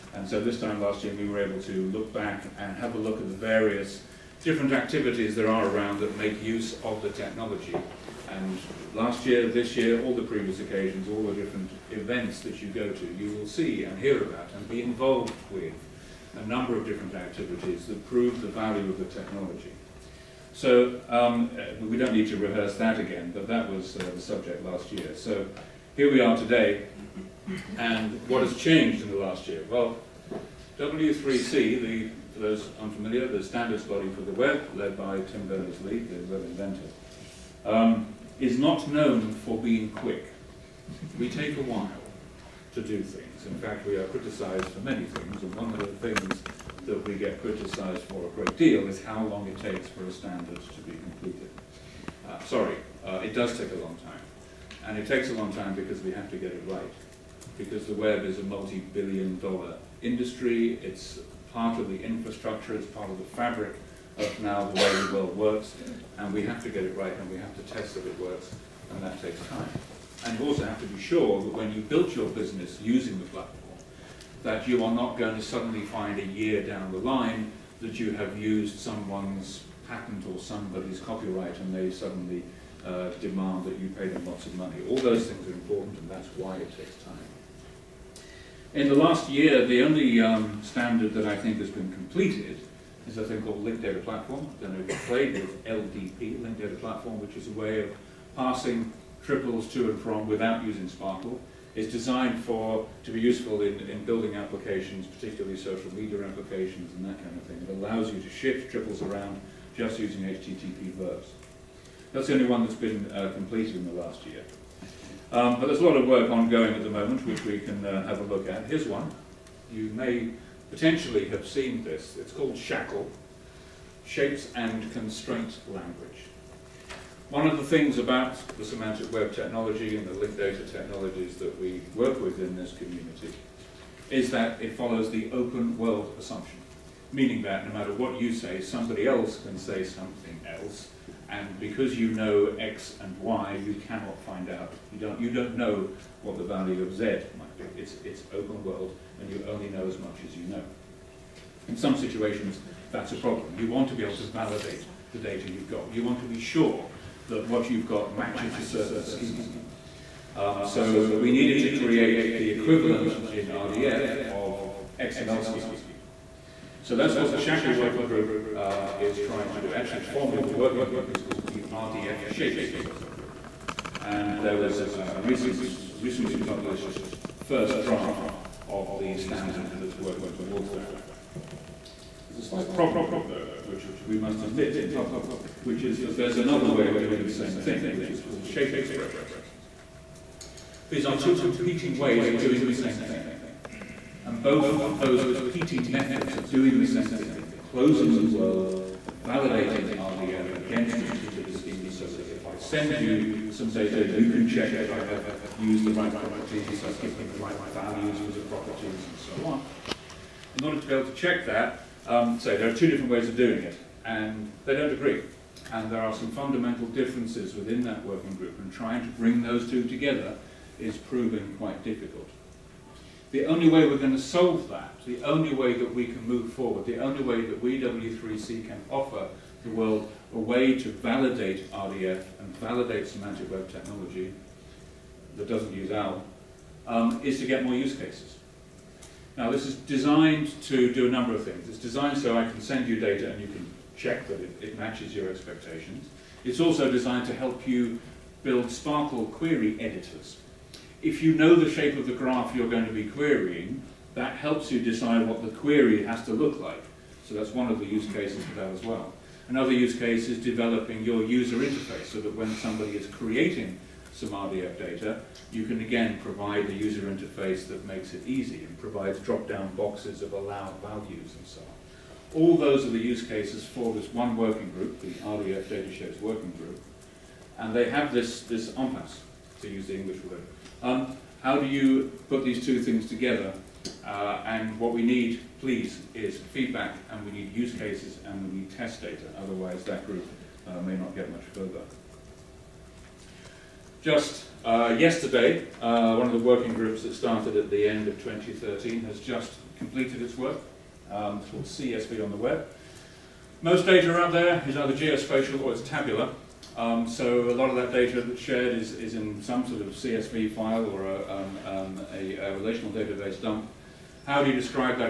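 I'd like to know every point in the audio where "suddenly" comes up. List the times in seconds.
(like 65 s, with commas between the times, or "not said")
75 s, 81 s.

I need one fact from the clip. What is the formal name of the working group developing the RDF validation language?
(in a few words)
RDF Shapes working group.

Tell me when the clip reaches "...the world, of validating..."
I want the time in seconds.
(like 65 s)
198 s.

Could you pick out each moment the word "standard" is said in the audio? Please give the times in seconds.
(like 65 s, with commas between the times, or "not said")
33 s, 50 s, 90 s, 179 s.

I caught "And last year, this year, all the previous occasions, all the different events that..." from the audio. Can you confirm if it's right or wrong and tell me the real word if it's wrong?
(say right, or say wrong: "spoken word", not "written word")
right.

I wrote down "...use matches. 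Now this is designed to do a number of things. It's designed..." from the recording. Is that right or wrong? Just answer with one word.
wrong.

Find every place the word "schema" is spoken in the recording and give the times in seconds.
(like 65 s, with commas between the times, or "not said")
159 s, 165 s, 201 s.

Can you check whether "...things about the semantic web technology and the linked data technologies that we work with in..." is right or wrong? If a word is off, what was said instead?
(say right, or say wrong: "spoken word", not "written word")
right.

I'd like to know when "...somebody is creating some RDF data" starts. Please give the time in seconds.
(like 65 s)
262 s.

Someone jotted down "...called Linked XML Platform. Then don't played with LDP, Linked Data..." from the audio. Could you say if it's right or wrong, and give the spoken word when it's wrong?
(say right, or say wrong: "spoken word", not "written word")
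wrong: "Data", not "XML".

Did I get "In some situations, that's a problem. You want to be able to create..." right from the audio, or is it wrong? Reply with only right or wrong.
wrong.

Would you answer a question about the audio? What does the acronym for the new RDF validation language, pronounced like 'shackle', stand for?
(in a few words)
Shapes and Constraint Language.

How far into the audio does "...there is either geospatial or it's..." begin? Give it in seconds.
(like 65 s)
304 s.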